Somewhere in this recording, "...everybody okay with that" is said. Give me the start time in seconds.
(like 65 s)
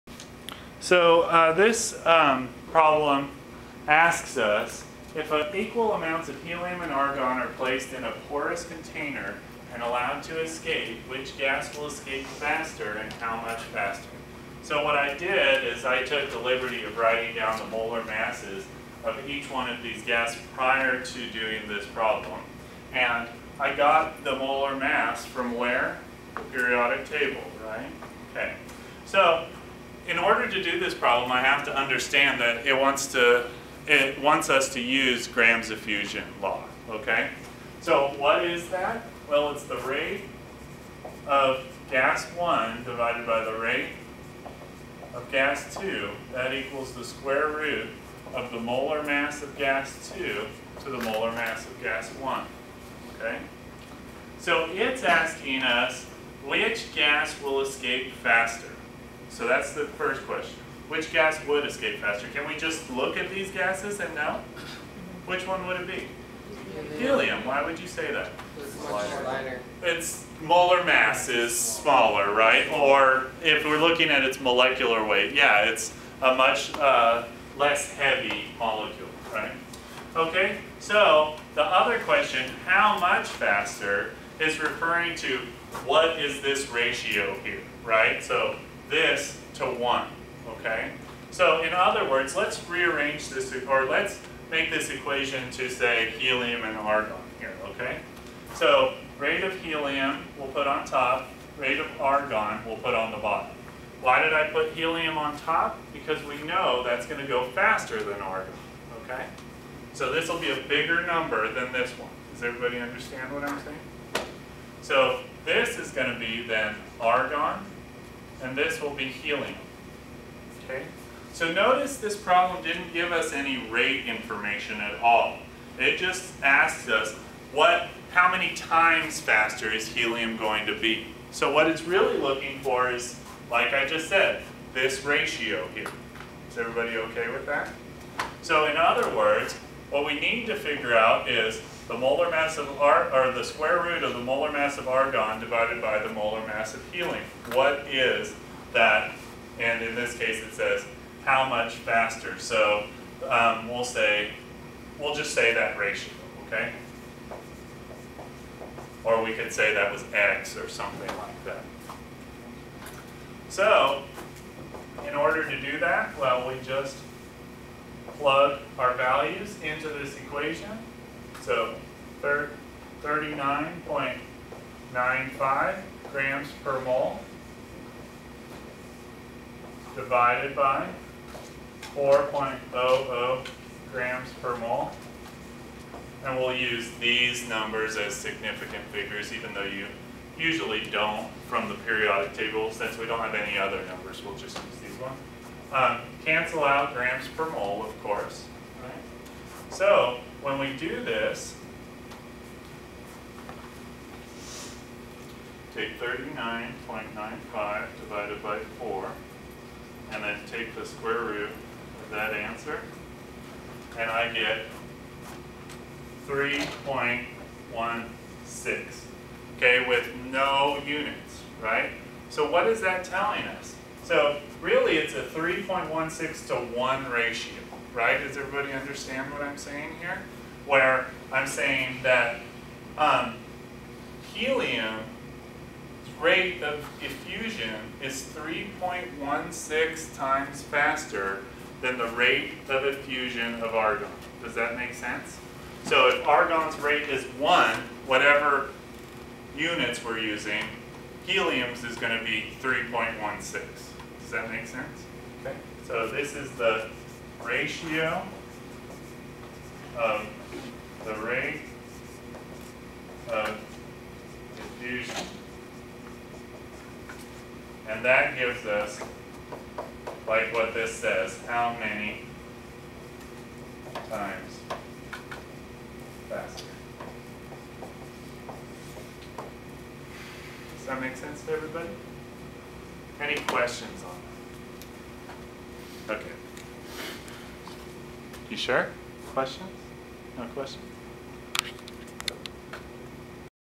136 s.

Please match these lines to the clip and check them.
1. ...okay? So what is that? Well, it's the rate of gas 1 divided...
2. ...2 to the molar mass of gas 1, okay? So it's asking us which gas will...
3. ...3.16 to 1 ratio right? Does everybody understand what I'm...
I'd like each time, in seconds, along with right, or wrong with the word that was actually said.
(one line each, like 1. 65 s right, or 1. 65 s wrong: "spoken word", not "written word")
1. 36 s right
2. 50 s right
3. 225 s right.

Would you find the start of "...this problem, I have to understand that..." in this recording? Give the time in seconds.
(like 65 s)
30 s.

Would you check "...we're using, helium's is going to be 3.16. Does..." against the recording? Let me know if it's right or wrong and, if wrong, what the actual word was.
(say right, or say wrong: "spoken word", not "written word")
right.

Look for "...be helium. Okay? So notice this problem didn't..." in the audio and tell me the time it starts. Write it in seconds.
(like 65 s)
118 s.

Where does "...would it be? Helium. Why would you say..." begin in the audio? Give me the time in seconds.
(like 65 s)
65 s.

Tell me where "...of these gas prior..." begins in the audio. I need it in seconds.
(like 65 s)
19 s.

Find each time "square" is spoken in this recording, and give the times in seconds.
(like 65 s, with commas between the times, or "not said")
47 s, 143 s, 210 s.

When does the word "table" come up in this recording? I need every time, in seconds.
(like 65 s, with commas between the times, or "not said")
27 s, 192 s.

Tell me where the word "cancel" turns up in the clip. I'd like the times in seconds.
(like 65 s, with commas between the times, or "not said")
196 s.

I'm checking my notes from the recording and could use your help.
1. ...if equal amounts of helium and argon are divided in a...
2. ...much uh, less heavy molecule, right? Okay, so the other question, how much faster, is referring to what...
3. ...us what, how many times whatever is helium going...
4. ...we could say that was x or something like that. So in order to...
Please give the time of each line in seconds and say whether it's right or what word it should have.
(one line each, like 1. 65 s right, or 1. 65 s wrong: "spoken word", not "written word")
1. 5 s wrong: "placed", not "divided"
2. 76 s right
3. 126 s wrong: "faster", not "whatever"
4. 159 s right.